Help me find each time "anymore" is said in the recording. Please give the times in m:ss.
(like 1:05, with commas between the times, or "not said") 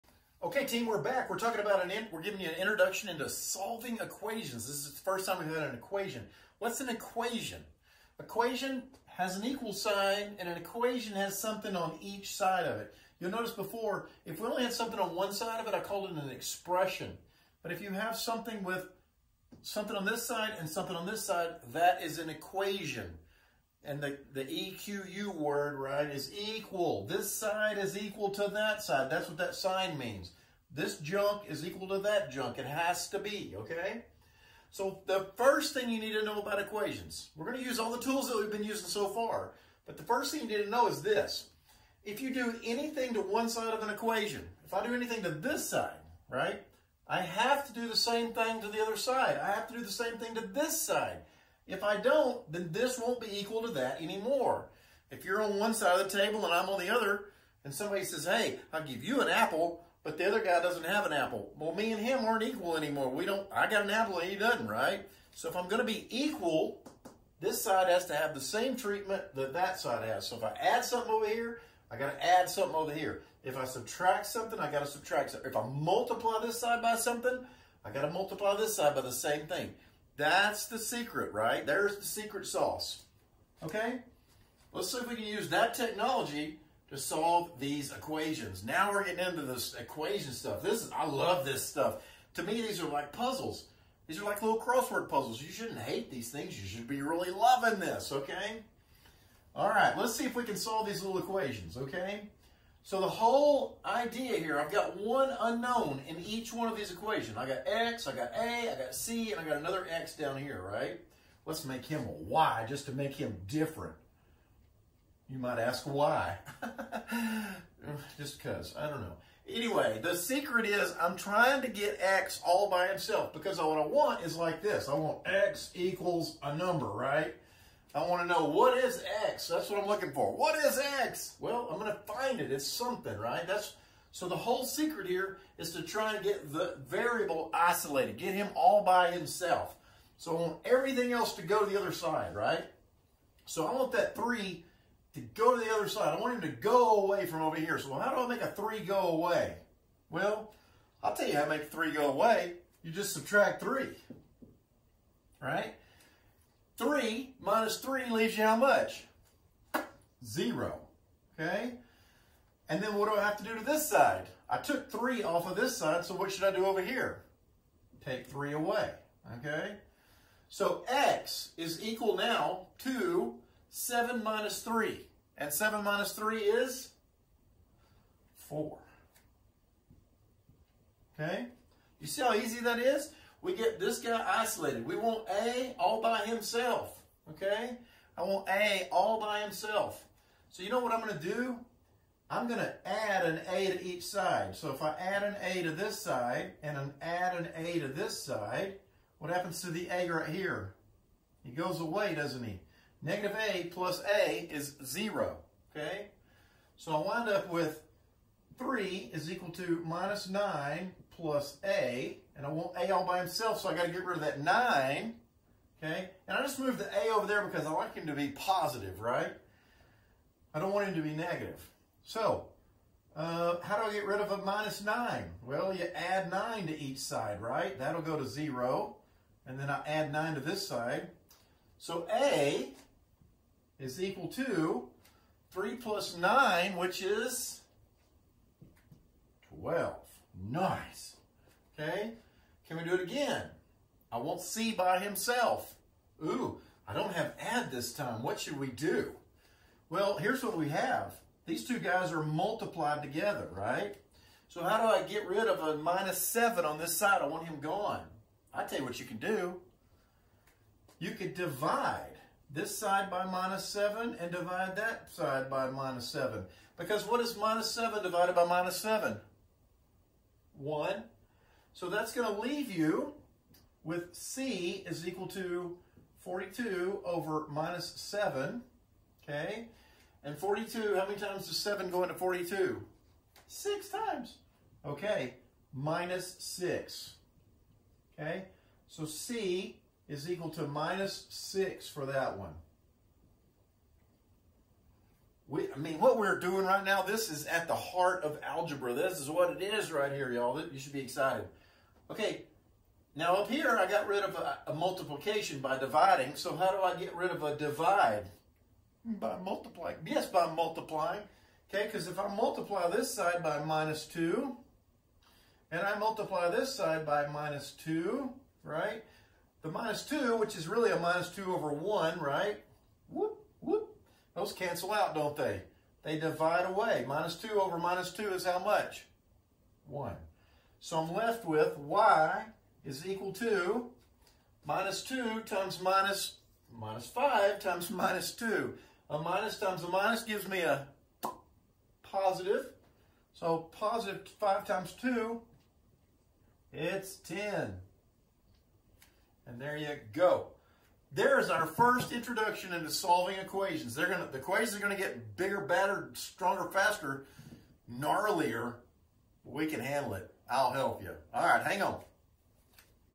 0:54, 1:02.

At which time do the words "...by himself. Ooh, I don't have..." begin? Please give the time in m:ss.
4:04.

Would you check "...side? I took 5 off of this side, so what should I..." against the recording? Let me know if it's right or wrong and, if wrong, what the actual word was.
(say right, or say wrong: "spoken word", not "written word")
wrong: "3", not "5".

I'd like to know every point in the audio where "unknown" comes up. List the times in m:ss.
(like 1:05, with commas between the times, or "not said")
1:45.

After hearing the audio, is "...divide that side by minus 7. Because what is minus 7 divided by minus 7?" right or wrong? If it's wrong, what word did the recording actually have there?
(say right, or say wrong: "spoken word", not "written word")
right.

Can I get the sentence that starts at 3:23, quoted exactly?
Negative a plus a is 0, okay?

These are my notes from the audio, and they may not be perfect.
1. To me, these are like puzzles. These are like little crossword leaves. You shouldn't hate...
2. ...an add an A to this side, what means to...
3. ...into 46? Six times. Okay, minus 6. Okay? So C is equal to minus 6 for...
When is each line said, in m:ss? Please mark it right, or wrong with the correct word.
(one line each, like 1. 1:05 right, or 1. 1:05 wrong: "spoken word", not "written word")
1. 1:32 wrong: "puzzles", not "leaves"
2. 3:16 wrong: "happens", not "means"
3. 4:42 wrong: "42", not "46".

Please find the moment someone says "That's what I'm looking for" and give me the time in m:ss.
2:09.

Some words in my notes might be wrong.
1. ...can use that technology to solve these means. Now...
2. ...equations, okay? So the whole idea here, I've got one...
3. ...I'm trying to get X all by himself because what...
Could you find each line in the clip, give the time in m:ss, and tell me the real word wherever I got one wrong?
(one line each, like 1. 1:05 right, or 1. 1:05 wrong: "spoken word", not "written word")
1. 1:25 wrong: "equations", not "means"
2. 1:41 right
3. 2:01 right.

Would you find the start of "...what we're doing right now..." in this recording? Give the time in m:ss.
4:55.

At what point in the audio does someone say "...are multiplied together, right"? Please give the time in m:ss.
4:12.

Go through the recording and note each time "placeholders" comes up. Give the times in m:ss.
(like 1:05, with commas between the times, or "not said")
not said.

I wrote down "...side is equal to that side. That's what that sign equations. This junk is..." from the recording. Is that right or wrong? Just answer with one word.
wrong.